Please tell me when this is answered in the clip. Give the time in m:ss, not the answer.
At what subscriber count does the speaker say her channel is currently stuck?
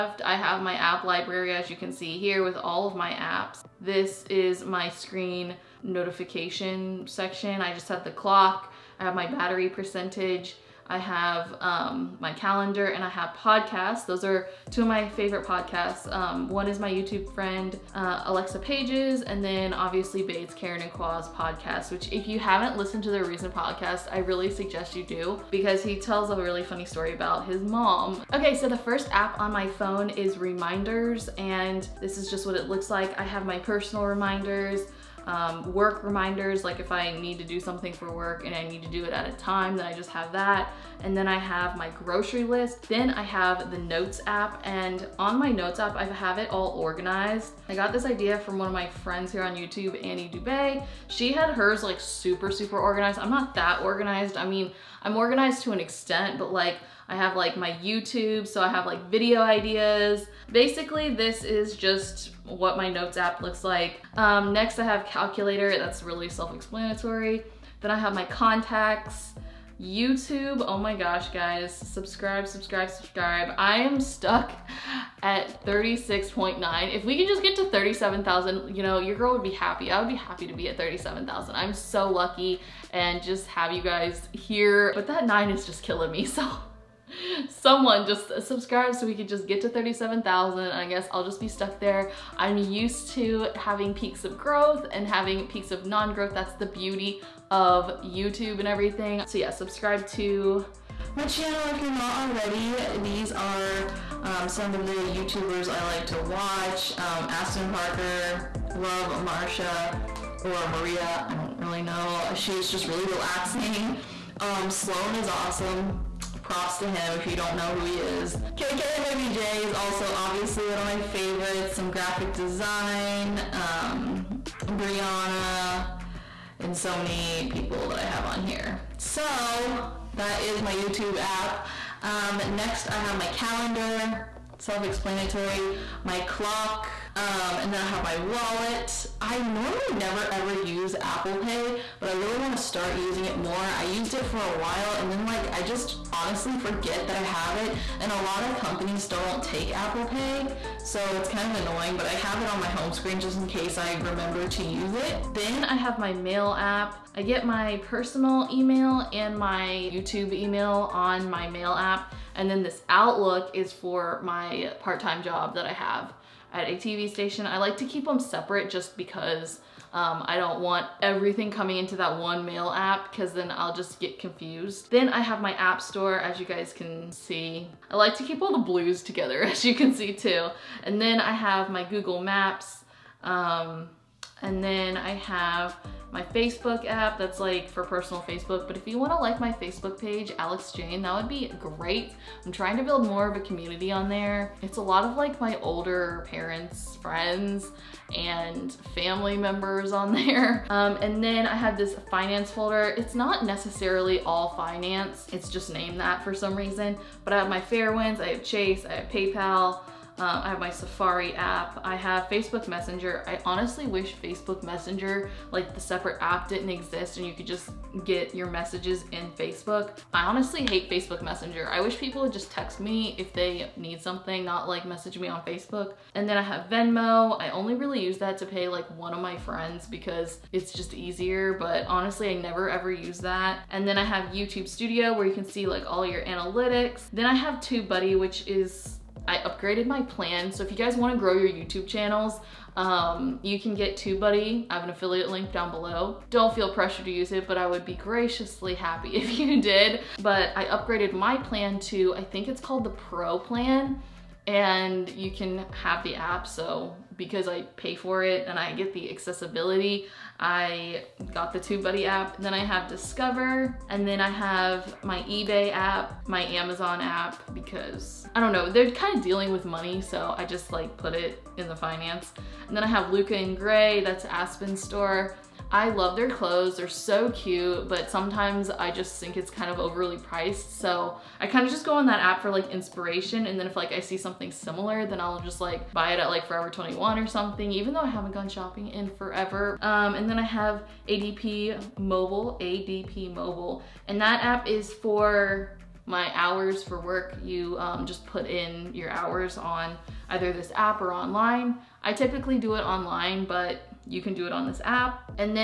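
1:15.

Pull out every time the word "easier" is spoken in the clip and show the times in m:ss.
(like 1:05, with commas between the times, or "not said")
3:50.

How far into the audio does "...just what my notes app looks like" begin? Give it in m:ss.
1:01.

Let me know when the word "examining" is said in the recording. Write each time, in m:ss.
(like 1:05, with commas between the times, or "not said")
not said.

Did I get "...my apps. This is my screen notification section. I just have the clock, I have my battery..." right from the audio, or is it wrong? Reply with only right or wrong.
right.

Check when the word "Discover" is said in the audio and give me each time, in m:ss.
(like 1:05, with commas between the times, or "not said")
4:22.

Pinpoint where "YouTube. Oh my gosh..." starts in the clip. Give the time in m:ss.
1:09.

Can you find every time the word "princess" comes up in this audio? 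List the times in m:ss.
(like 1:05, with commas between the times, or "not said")
not said.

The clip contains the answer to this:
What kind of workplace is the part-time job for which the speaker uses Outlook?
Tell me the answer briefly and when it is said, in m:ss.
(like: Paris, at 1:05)
TV station, at 2:46.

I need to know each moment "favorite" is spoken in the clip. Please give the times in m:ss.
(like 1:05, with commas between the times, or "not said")
0:15, 2:00.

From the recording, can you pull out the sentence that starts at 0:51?
She had hers like super, super organized.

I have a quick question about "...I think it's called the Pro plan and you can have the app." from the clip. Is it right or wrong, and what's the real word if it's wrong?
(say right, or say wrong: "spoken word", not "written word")
right.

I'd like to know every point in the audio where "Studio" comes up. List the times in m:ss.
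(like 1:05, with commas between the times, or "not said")
3:54.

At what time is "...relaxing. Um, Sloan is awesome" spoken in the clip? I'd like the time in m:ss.
1:53.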